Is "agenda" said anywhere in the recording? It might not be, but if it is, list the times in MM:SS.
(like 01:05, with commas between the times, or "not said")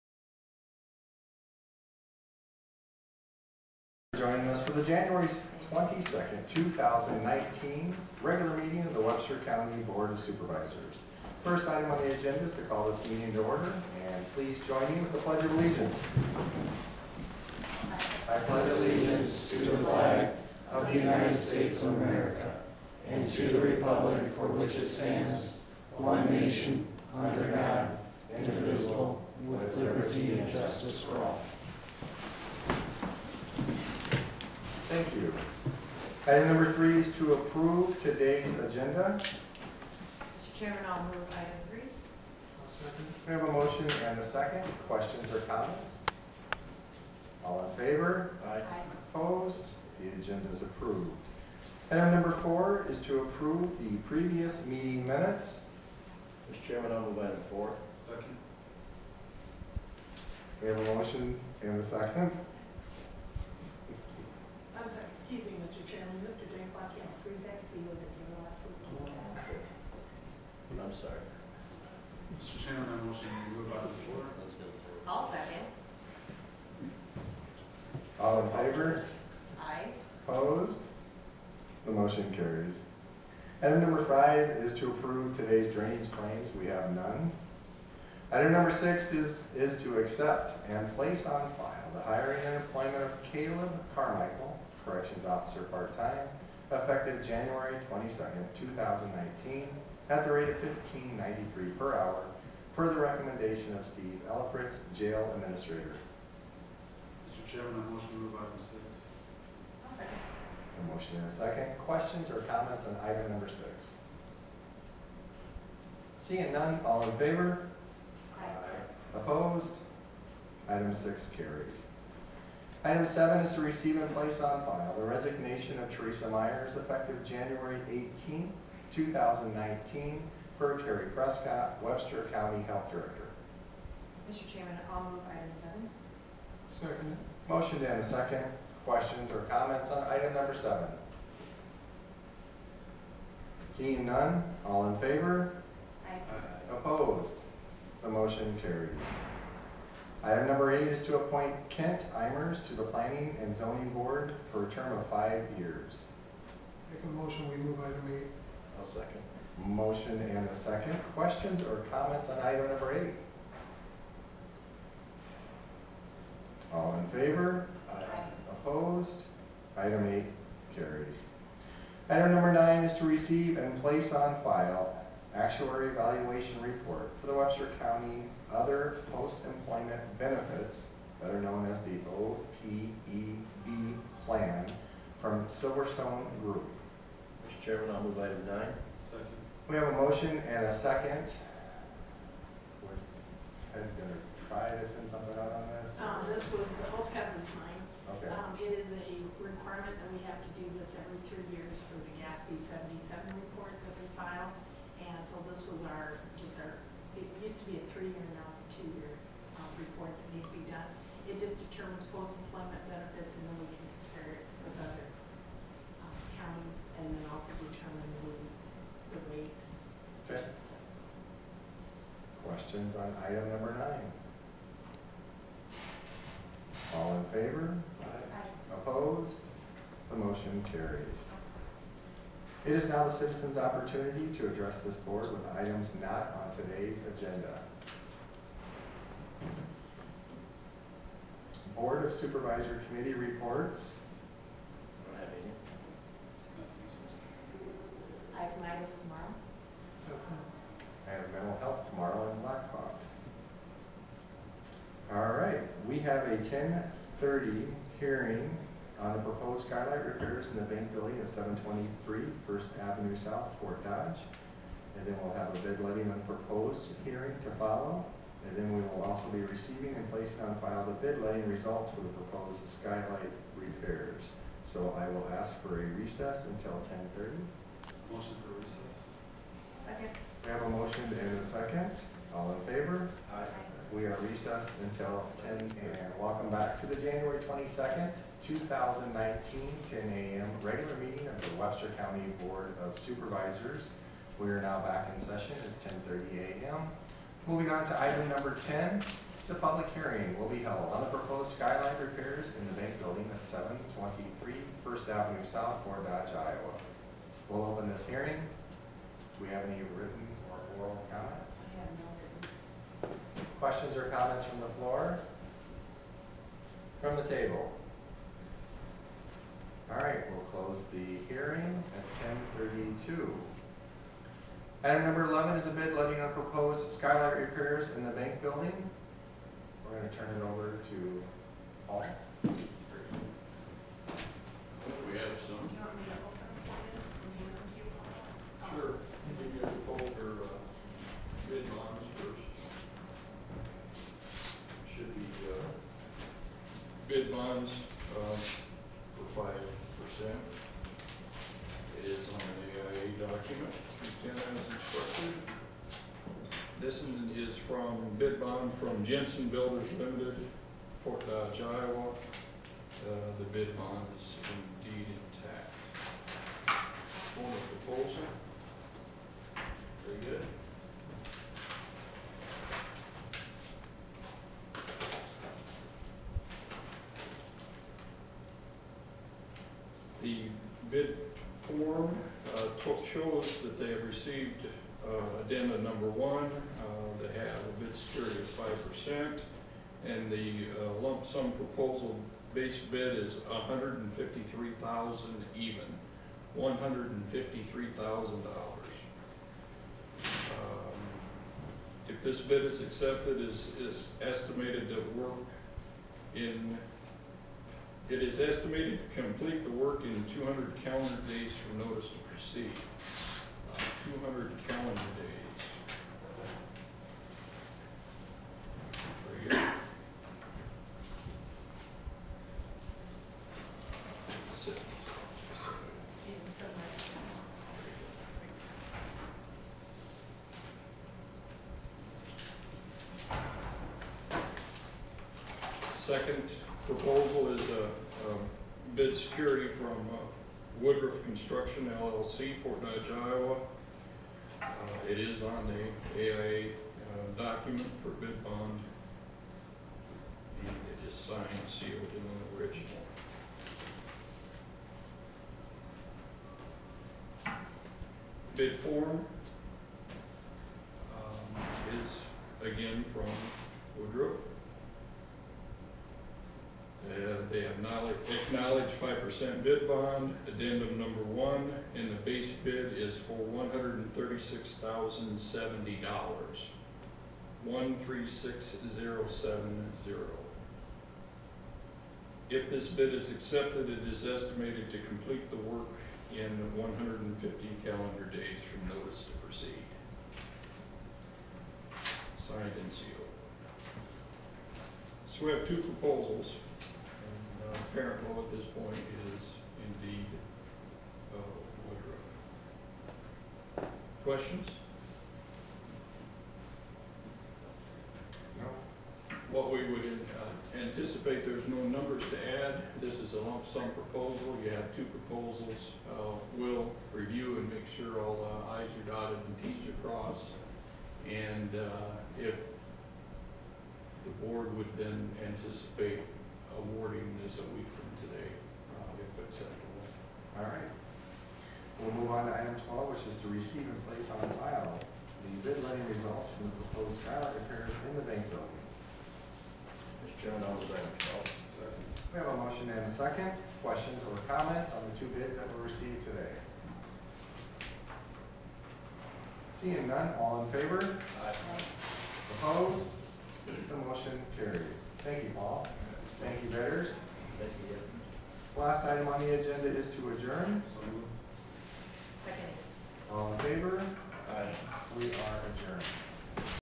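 00:12, 00:38, 00:50, 03:57, 09:19.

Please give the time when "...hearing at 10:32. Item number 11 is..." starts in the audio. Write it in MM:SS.
05:21.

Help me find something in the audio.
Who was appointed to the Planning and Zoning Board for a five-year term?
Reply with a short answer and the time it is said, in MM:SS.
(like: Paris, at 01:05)
Kent Imers, at 02:31.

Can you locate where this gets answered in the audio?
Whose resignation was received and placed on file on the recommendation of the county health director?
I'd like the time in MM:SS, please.
02:05.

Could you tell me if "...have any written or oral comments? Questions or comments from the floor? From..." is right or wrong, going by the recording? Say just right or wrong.
right.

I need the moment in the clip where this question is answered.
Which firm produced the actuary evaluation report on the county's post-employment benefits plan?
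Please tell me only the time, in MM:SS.
03:05.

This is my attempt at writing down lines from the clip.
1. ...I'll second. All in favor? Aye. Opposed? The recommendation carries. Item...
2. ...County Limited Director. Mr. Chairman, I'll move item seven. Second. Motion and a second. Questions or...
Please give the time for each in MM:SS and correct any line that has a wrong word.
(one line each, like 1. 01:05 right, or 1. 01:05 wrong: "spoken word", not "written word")
1. 01:15 wrong: "motion", not "recommendation"
2. 02:12 wrong: "Health", not "Limited".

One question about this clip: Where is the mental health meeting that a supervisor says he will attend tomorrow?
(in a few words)
Black Hawk.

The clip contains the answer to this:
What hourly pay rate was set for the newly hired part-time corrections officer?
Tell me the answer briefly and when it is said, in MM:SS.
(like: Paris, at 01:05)
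$15.93, at 01:40.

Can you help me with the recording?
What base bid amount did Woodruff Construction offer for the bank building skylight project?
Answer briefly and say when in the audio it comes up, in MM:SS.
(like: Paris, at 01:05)
$136,070, at 07:53.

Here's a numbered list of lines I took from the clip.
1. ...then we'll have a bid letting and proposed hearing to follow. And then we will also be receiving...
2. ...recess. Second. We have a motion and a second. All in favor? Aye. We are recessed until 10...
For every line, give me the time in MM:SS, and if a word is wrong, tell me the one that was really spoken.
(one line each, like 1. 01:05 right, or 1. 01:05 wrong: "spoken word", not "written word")
1. 04:25 right
2. 04:38 right.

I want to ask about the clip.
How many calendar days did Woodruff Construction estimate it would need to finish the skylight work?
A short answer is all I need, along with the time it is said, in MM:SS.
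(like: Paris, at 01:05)
150, at 08:06.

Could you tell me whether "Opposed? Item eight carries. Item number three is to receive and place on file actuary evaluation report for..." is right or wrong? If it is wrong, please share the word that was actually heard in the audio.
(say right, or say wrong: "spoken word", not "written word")
wrong: "nine", not "three".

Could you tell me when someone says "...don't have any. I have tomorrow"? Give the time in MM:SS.
04:05.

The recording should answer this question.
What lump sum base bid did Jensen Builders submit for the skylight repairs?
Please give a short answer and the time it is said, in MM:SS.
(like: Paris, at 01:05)
$153,000, at 06:36.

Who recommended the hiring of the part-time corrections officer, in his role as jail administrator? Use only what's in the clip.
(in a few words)
Steve Elfritz.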